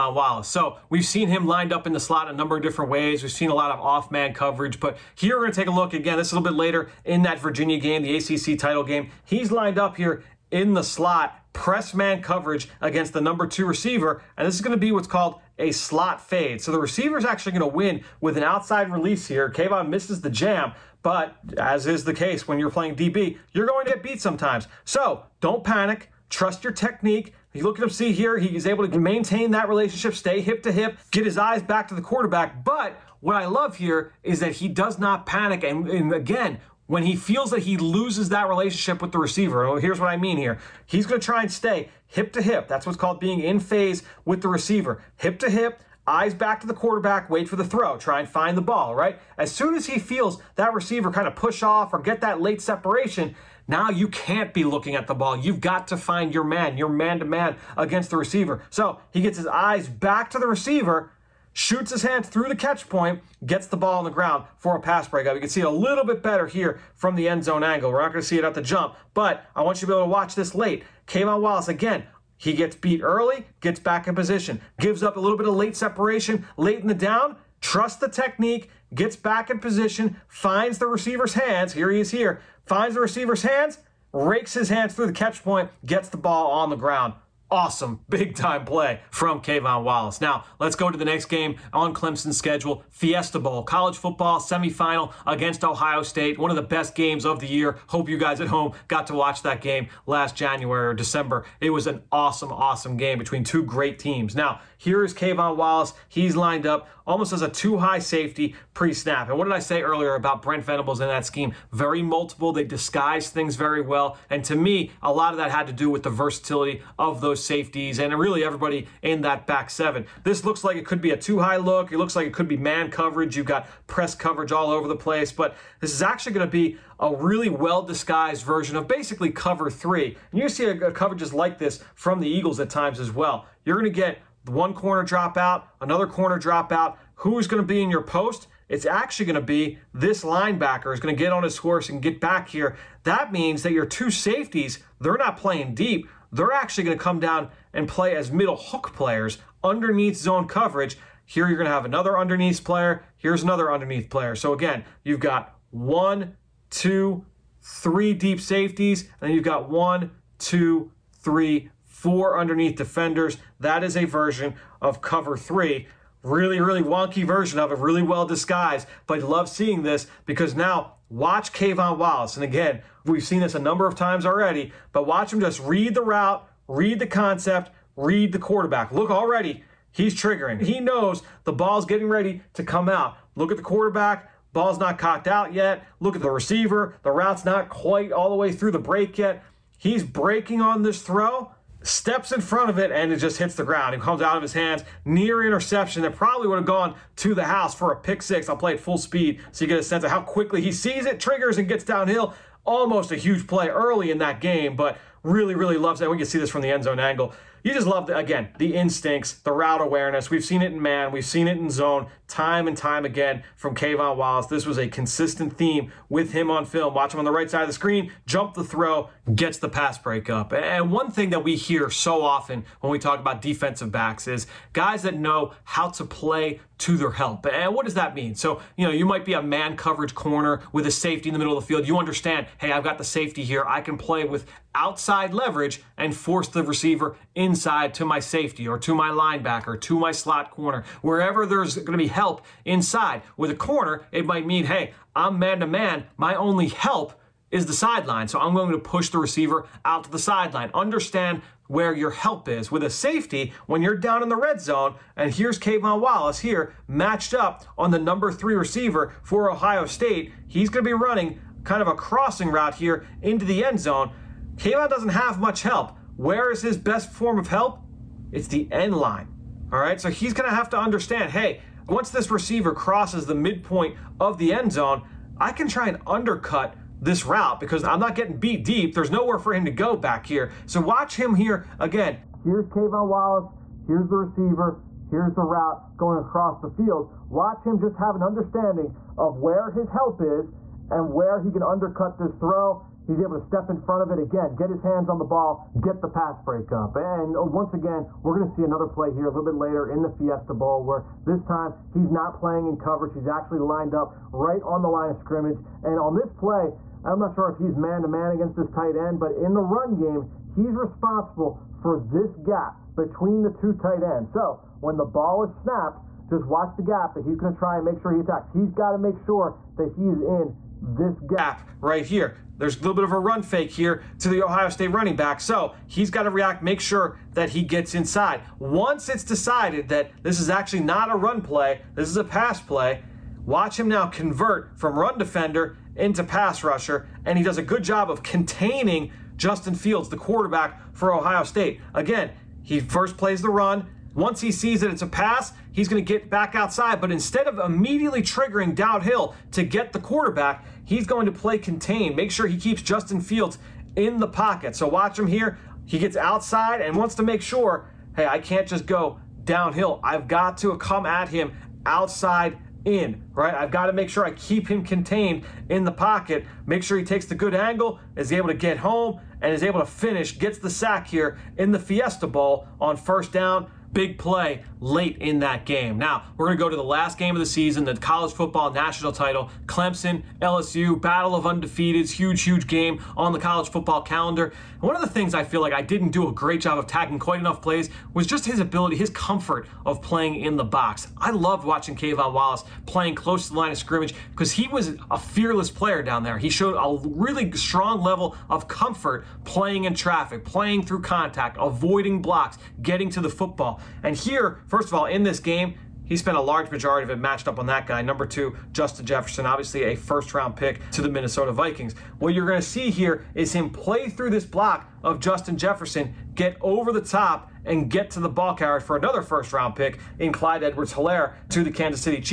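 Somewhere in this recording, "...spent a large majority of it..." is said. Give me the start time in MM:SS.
06:46.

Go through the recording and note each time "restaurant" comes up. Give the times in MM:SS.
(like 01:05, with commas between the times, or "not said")
not said.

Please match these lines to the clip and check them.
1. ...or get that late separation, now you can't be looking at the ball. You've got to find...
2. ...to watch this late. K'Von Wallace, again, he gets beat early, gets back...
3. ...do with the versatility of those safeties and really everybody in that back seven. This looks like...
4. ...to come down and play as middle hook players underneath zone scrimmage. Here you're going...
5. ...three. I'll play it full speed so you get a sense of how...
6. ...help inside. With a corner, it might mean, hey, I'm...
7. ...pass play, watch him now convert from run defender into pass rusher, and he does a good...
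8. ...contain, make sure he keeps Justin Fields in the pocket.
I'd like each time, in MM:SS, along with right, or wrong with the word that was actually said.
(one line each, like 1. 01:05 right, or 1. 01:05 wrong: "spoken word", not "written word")
1. 00:51 right
2. 01:10 right
3. 01:55 right
4. 02:26 wrong: "coverage", not "scrimmage"
5. 03:18 wrong: "six", not "three"
6. 04:02 right
7. 05:32 right
8. 05:51 right.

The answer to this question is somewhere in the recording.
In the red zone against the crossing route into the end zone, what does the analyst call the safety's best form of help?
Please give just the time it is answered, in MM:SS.
04:28.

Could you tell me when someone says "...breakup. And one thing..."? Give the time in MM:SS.
03:39.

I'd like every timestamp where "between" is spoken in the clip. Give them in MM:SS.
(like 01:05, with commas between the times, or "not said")
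01:43, 05:12.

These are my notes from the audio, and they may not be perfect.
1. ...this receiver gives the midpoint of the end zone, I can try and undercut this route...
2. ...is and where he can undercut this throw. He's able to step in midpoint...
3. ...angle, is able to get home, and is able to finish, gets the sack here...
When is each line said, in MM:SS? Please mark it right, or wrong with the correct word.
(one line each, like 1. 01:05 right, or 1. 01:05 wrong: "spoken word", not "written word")
1. 04:32 wrong: "crosses", not "gives"
2. 04:50 wrong: "front", not "midpoint"
3. 06:07 right.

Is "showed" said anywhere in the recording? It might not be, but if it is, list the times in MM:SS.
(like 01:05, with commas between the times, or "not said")
06:36.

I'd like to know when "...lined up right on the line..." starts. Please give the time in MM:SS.
05:03.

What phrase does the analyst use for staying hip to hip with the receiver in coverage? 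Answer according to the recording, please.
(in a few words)
In phase.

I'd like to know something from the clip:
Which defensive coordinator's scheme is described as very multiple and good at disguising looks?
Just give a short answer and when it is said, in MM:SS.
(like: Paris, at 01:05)
Brent Venables, at 01:50.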